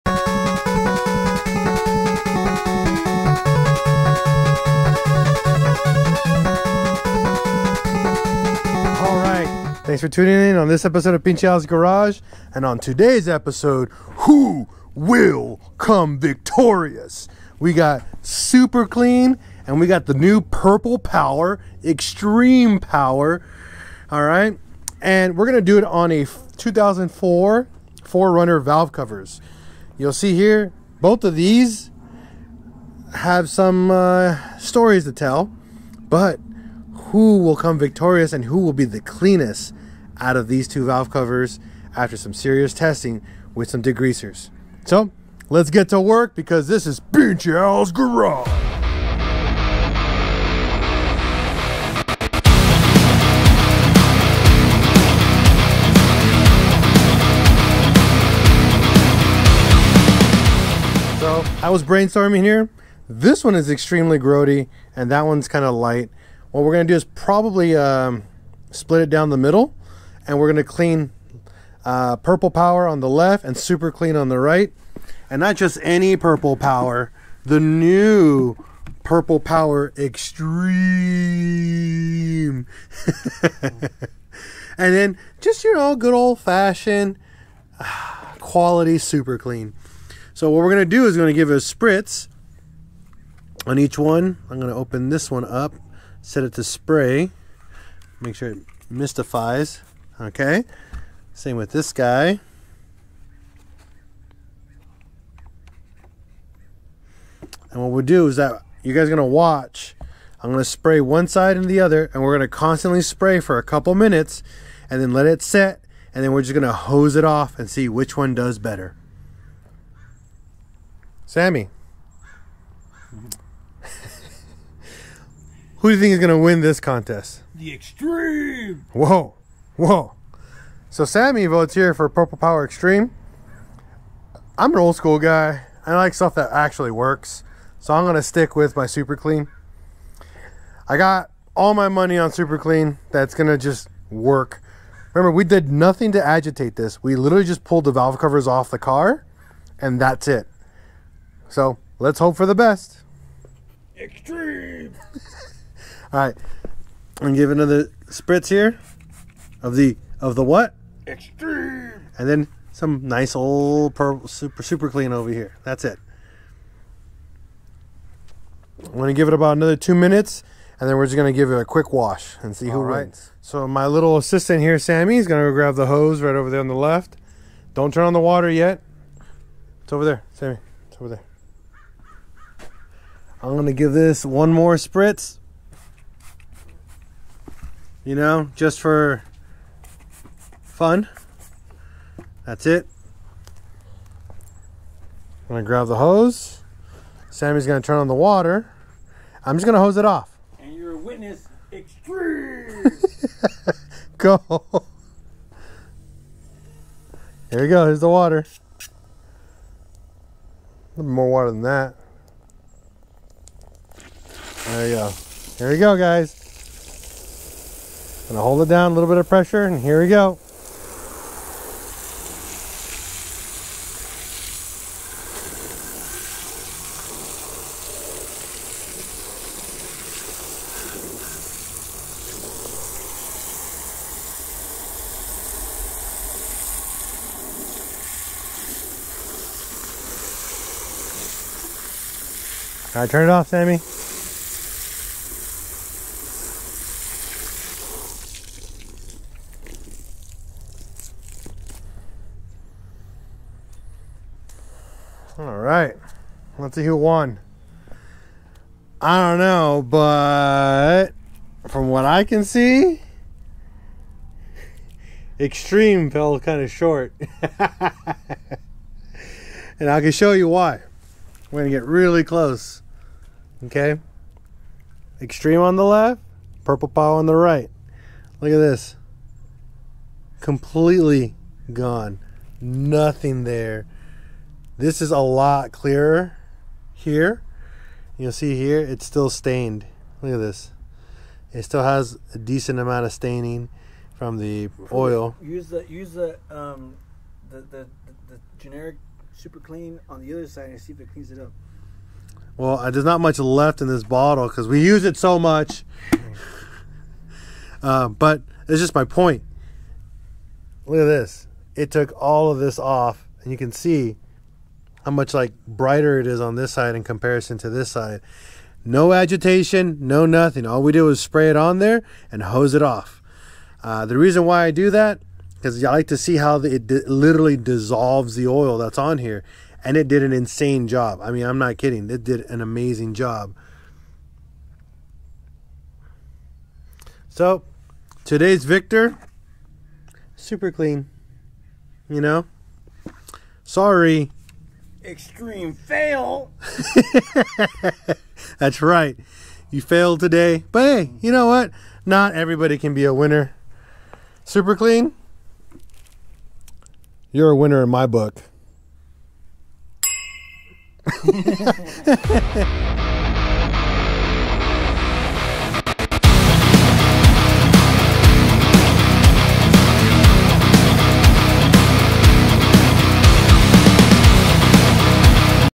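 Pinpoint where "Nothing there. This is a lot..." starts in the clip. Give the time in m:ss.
4:42.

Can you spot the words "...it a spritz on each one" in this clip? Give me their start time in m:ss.
1:31.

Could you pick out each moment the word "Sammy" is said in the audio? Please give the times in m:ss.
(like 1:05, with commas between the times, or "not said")
2:01, 2:11, 2:54, 3:00, 3:17, 4:03.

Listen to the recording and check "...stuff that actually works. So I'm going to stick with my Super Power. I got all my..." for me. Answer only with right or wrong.
wrong.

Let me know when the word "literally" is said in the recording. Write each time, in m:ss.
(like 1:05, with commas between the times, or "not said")
2:27, 5:27.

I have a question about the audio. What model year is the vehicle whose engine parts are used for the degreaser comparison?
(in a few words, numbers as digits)
2004.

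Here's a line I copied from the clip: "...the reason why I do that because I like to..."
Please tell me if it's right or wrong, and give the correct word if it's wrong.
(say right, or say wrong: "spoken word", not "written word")
right.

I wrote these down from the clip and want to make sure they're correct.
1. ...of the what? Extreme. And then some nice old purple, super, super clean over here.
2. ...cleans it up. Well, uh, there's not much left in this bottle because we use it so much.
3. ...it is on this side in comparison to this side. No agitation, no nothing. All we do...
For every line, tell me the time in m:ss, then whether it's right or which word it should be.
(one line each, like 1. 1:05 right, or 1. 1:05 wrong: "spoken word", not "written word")
1. 2:40 right
2. 5:01 right
3. 5:16 right.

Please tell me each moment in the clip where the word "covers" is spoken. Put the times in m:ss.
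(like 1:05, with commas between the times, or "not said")
0:28, 0:41, 2:28.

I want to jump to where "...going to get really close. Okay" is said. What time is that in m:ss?
4:31.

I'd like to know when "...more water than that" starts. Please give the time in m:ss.
3:31.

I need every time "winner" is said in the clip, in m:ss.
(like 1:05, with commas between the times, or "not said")
5:53, 5:57.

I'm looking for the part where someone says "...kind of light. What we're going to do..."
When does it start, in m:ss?
1:05.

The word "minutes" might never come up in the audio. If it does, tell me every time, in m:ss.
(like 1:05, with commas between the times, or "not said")
1:53, 2:49.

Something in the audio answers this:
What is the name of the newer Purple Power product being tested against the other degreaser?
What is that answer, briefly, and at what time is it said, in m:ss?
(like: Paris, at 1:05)
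Extreme Power, at 0:21.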